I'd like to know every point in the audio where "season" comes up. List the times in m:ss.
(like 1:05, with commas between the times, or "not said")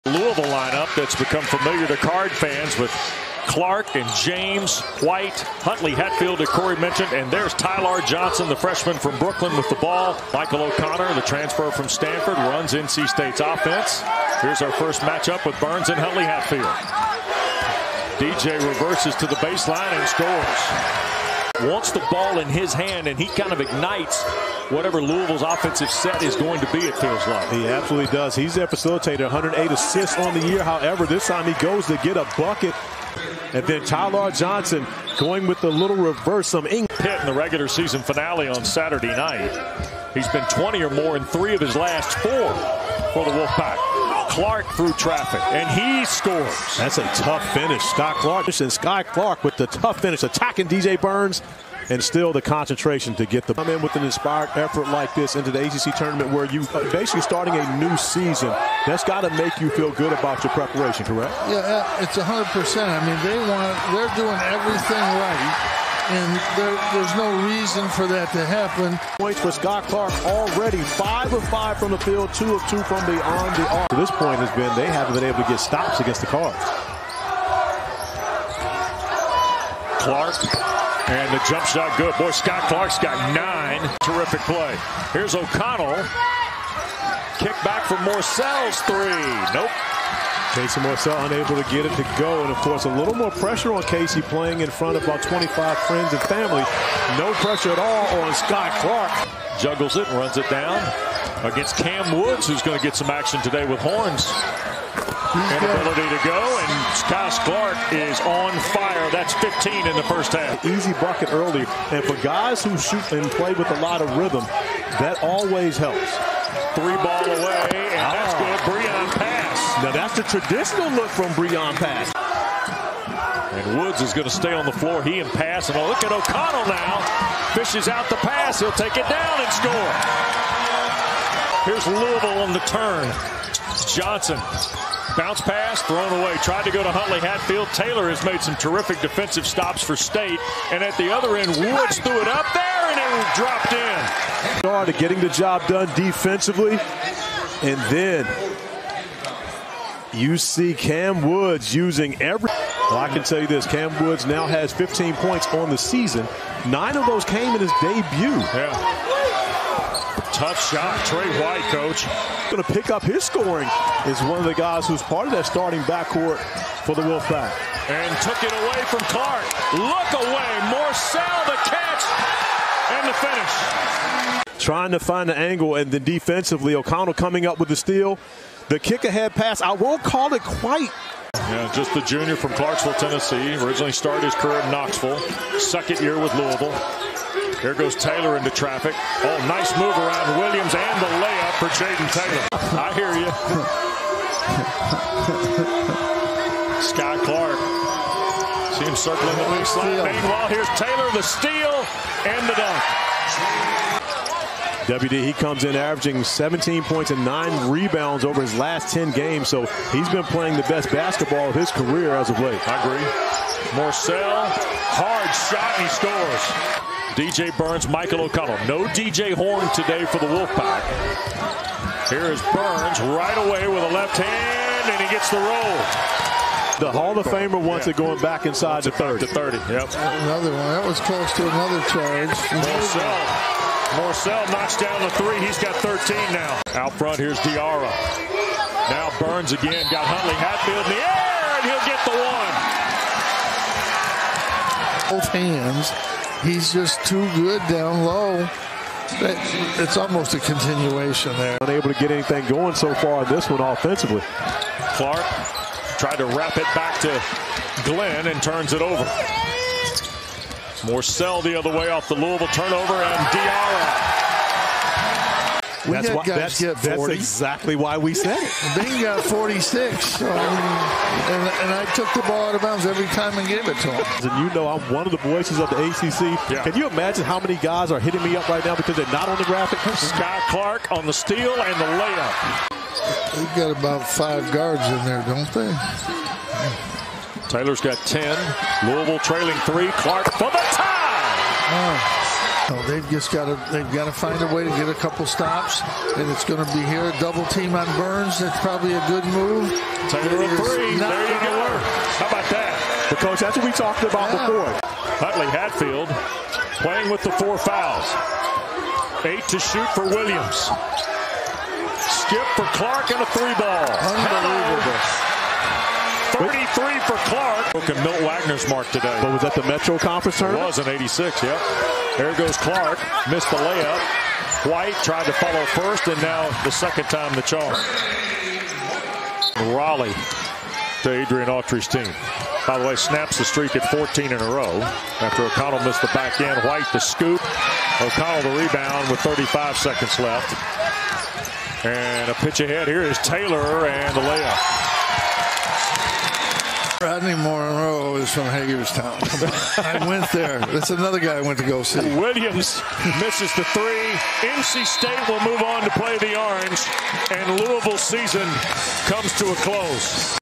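0:37, 0:57, 2:35, 5:57.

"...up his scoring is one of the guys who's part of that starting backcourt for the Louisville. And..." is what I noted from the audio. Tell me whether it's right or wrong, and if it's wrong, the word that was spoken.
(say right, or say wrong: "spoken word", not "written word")
wrong: "Wolfpack", not "Louisville".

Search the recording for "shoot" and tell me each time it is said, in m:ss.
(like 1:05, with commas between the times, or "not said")
1:52, 5:09.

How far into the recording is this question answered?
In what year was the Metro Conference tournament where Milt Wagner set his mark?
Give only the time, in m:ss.
5:20.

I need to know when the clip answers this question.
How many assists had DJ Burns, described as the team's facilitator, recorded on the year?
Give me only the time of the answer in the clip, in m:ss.
0:29.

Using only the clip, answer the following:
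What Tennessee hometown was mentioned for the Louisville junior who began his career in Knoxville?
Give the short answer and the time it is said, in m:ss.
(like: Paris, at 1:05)
Clarksville, Tennessee, at 3:02.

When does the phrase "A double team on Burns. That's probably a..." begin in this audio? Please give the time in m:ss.
4:57.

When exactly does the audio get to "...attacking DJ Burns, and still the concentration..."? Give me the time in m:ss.
0:50.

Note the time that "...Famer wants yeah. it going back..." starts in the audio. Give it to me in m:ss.
3:47.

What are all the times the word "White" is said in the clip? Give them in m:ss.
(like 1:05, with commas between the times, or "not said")
0:05, 2:41, 5:24, 5:36.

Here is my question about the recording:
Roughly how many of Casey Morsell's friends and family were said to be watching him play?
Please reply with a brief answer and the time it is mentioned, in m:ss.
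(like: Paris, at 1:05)
25, at 1:35.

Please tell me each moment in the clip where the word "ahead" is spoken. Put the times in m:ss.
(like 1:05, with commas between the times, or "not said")
2:59, 5:42.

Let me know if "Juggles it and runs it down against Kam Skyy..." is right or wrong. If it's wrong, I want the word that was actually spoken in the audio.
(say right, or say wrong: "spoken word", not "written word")
wrong: "Woods", not "Skyy".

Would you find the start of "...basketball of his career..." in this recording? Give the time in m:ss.
3:30.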